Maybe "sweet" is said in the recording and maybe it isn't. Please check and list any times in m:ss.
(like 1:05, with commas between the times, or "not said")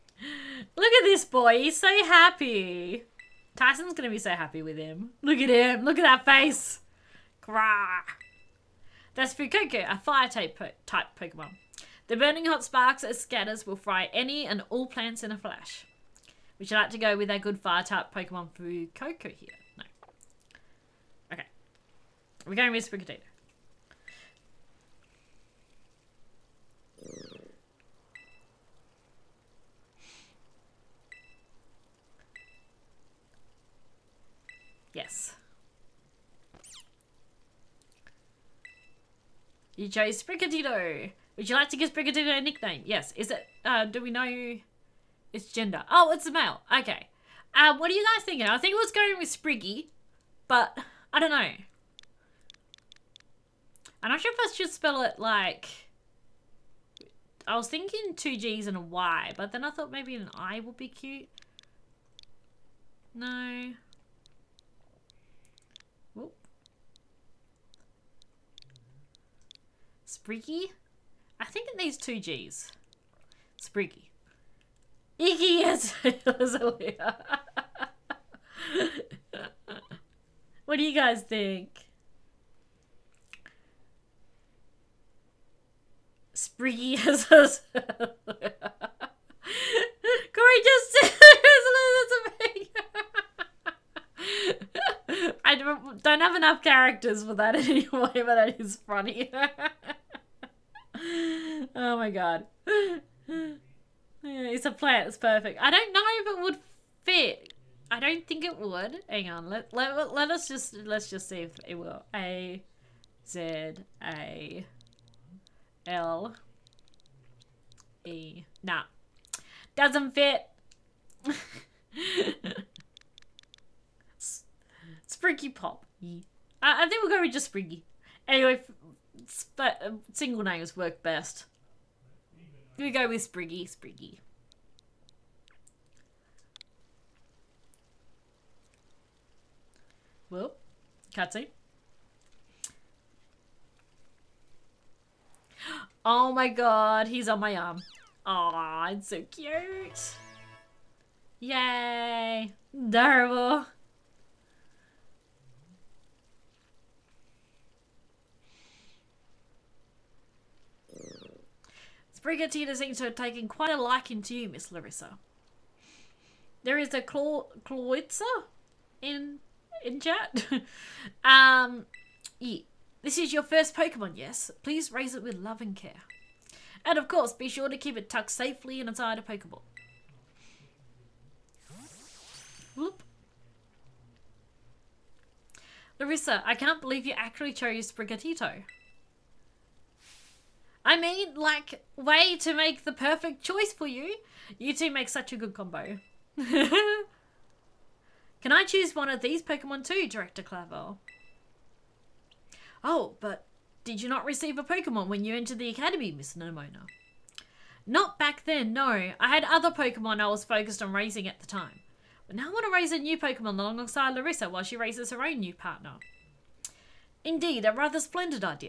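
0:22.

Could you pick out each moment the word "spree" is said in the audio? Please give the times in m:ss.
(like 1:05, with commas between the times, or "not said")
1:26.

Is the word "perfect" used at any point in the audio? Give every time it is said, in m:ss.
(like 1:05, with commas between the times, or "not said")
1:45, 3:12.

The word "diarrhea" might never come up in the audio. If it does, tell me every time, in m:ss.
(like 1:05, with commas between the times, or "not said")
not said.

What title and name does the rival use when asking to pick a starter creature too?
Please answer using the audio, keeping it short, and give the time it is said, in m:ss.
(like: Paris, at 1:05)
Director Clavel, at 3:20.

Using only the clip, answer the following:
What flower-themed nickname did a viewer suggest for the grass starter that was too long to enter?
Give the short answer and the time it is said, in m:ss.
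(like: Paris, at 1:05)
Azalea, at 1:16.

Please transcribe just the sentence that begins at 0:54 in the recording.
I'm not sure if I should spell it like...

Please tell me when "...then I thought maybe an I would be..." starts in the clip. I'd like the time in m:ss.
0:59.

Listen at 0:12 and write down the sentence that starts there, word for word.
The burning hot sparks as scatters will fry any and all plants in a flash.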